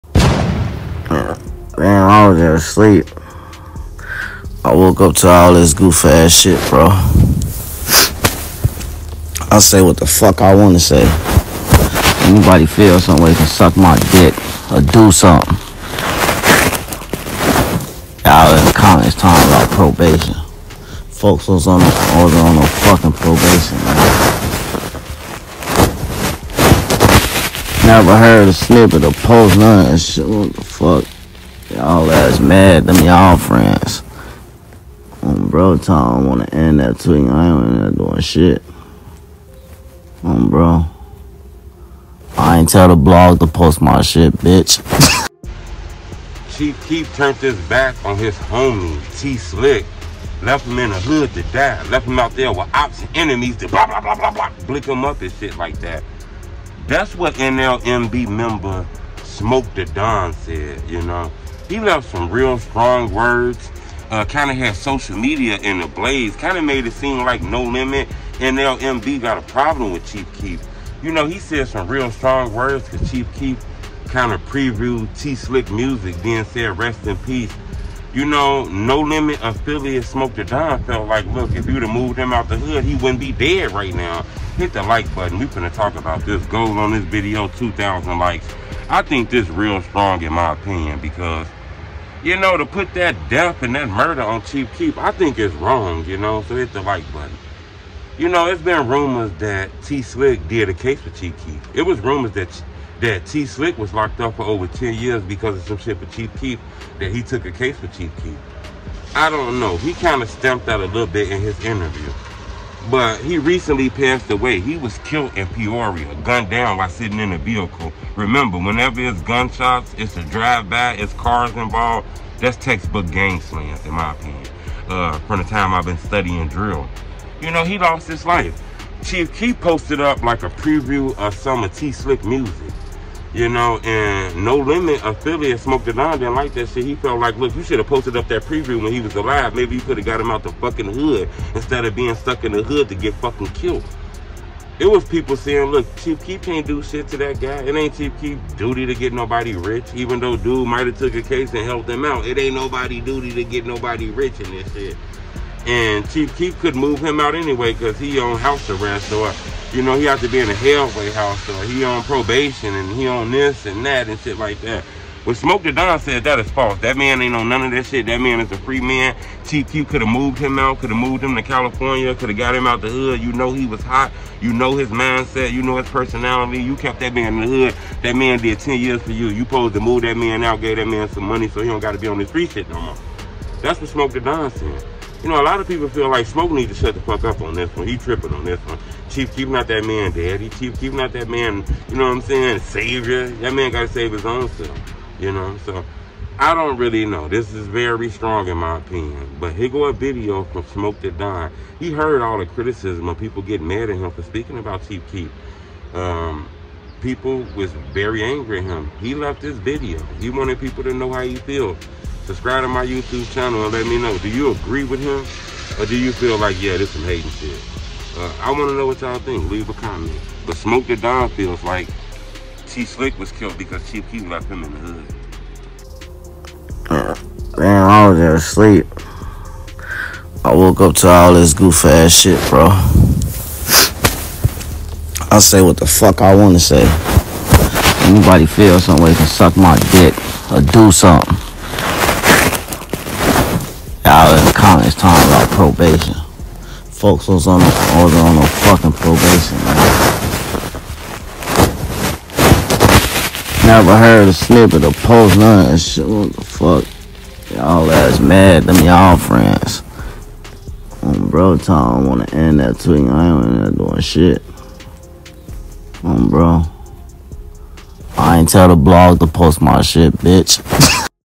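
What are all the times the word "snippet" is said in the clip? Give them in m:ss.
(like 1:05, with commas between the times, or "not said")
0:28, 4:14.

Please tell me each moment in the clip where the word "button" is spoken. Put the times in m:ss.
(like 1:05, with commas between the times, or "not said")
1:25, 1:37.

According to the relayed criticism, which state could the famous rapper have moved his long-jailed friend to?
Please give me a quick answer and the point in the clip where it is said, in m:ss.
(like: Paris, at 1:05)
California, at 2:51.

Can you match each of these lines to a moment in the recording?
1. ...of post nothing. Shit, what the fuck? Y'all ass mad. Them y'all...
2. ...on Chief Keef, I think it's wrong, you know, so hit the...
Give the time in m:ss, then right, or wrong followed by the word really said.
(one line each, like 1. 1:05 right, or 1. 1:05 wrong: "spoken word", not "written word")
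1. 0:29 right
2. 1:34 right.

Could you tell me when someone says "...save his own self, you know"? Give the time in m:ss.
3:13.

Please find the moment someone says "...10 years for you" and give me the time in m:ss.
2:58.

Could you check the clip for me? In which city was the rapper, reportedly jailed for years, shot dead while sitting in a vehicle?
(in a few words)
Peoria.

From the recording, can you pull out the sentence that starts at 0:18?
Y'all in the comments talking about probation.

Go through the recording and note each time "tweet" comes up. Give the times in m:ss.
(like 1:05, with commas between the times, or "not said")
0:36, 4:22.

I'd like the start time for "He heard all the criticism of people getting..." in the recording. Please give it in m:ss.
3:21.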